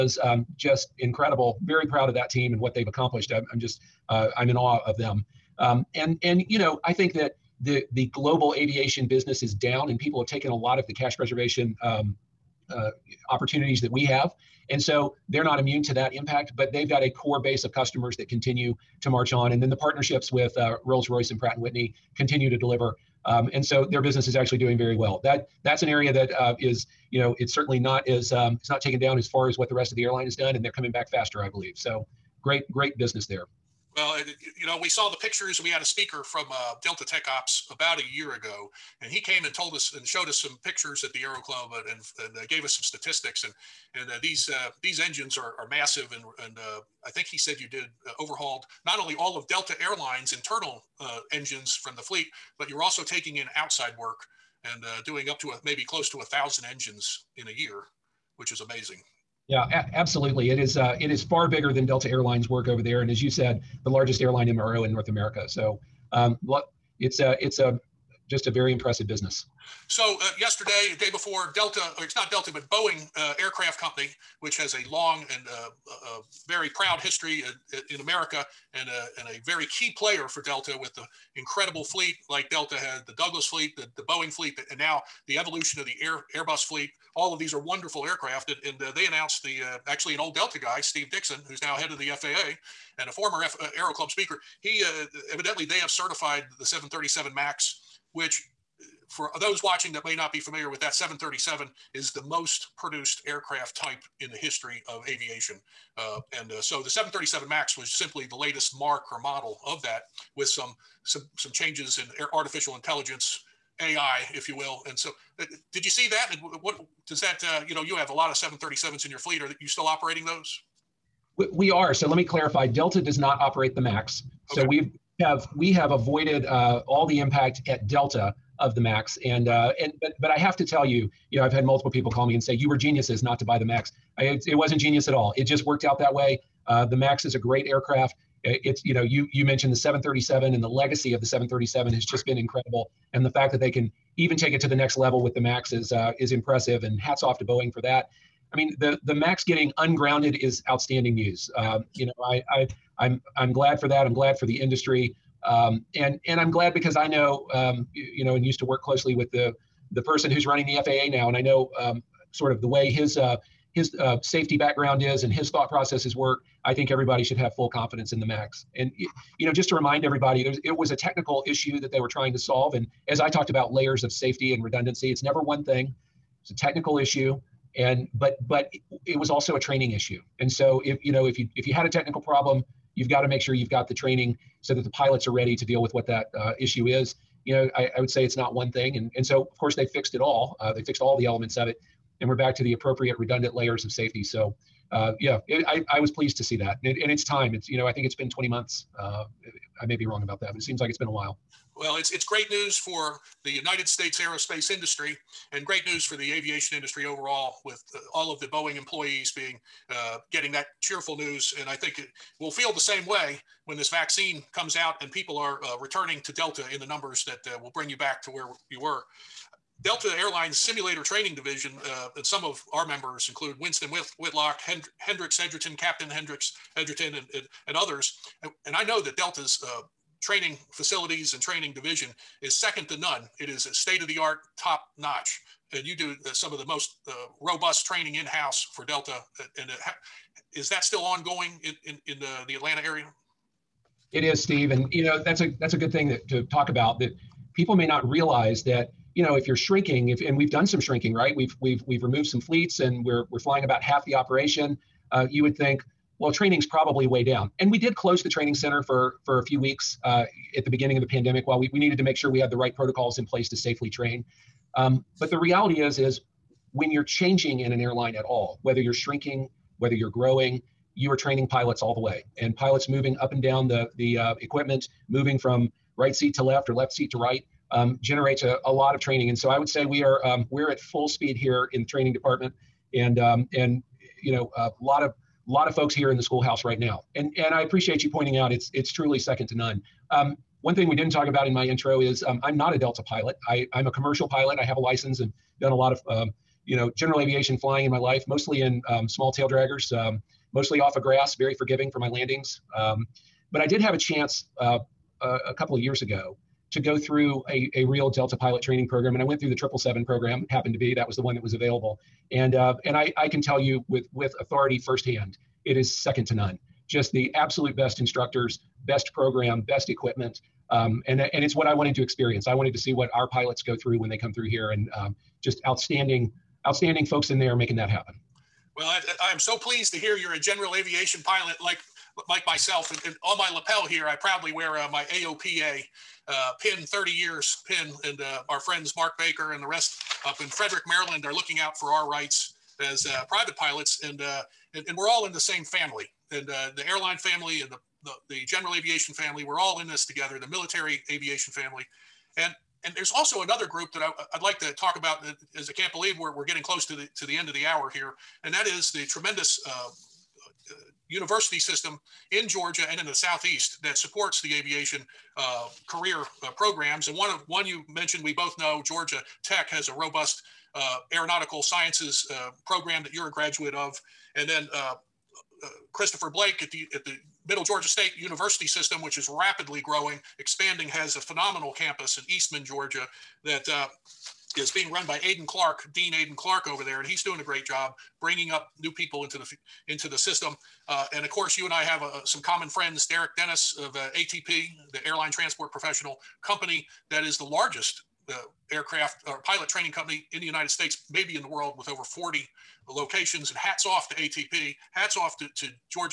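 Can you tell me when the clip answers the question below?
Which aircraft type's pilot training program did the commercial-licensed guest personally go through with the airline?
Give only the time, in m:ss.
5:09.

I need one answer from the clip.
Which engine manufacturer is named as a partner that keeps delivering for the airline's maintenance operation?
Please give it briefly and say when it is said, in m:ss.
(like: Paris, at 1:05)
Rolls Royce, at 0:20.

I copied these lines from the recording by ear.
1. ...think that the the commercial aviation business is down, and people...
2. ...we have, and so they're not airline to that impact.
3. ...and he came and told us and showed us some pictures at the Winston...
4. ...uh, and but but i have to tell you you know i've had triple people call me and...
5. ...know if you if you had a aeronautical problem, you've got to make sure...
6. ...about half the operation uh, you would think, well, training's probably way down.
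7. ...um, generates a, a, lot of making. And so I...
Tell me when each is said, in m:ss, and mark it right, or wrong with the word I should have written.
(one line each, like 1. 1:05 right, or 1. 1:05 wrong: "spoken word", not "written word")
1. 0:06 wrong: "global", not "commercial"
2. 0:13 wrong: "immune", not "airline"
3. 0:39 wrong: "Aero", not "Winston"
4. 2:09 wrong: "multiple", not "triple"
5. 3:01 wrong: "technical", not "aeronautical"
6. 4:13 right
7. 4:37 wrong: "training", not "making".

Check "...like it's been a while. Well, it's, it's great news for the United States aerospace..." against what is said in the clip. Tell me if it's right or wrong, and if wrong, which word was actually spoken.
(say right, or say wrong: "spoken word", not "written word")
right.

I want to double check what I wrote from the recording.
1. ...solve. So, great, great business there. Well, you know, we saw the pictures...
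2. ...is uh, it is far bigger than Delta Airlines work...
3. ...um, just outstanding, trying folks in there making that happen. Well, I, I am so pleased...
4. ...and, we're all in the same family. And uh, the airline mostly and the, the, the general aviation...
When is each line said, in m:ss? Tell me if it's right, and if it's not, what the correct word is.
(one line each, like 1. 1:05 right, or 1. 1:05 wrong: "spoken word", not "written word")
1. 0:31 wrong: "believe", not "solve"
2. 1:00 right
3. 5:24 wrong: "outstanding", not "trying"
4. 5:44 wrong: "family", not "mostly".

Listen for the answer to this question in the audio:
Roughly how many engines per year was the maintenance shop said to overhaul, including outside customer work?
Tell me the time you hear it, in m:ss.
0:56.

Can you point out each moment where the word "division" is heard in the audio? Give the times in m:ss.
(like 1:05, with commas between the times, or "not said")
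3:41, 3:51.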